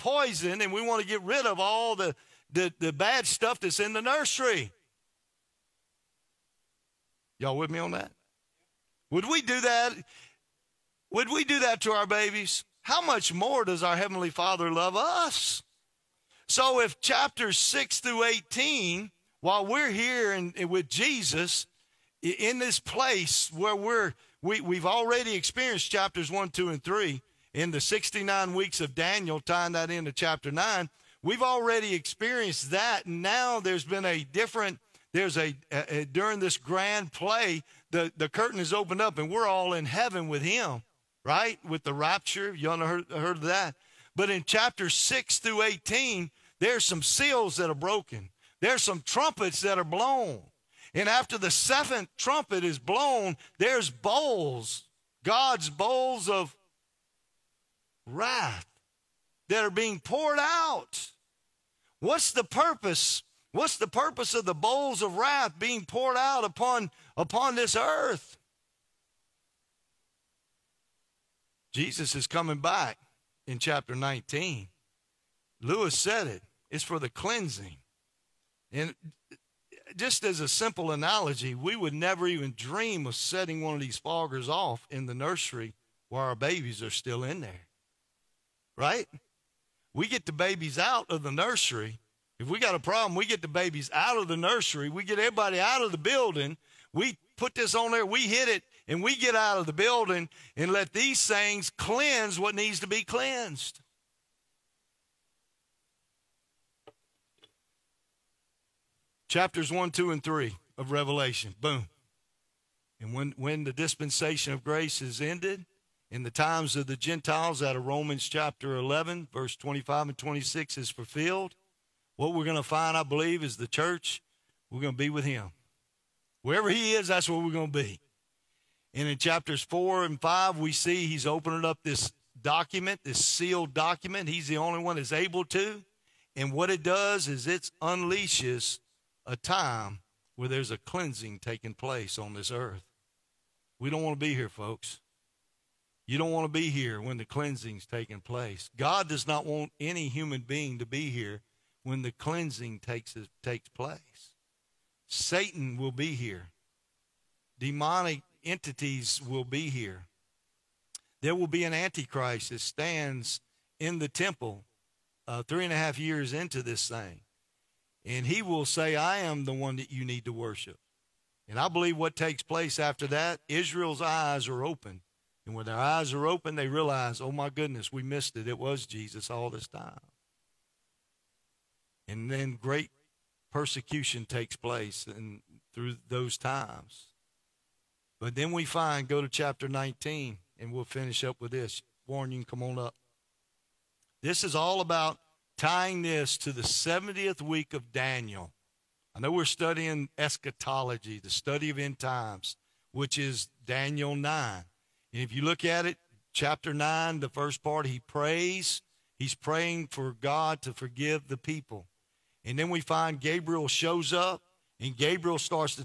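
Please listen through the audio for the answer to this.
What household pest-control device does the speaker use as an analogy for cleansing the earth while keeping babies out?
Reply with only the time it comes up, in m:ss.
1:23.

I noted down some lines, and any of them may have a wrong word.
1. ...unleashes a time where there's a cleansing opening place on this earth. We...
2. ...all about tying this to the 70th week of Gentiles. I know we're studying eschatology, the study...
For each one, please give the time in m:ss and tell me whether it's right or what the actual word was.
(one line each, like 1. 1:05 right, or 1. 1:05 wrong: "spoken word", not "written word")
1. 2:17 wrong: "taking", not "opening"
2. 3:14 wrong: "Daniel", not "Gentiles".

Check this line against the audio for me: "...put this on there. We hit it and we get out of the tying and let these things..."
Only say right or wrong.
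wrong.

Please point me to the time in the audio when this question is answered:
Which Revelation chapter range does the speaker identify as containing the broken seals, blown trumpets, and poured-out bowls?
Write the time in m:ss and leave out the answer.
0:16.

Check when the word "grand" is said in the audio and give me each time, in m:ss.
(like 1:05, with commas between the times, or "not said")
0:36.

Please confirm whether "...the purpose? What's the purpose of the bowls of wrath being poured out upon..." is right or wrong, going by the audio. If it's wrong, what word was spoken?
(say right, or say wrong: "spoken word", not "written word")
right.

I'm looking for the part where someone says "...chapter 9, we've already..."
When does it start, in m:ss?
0:30.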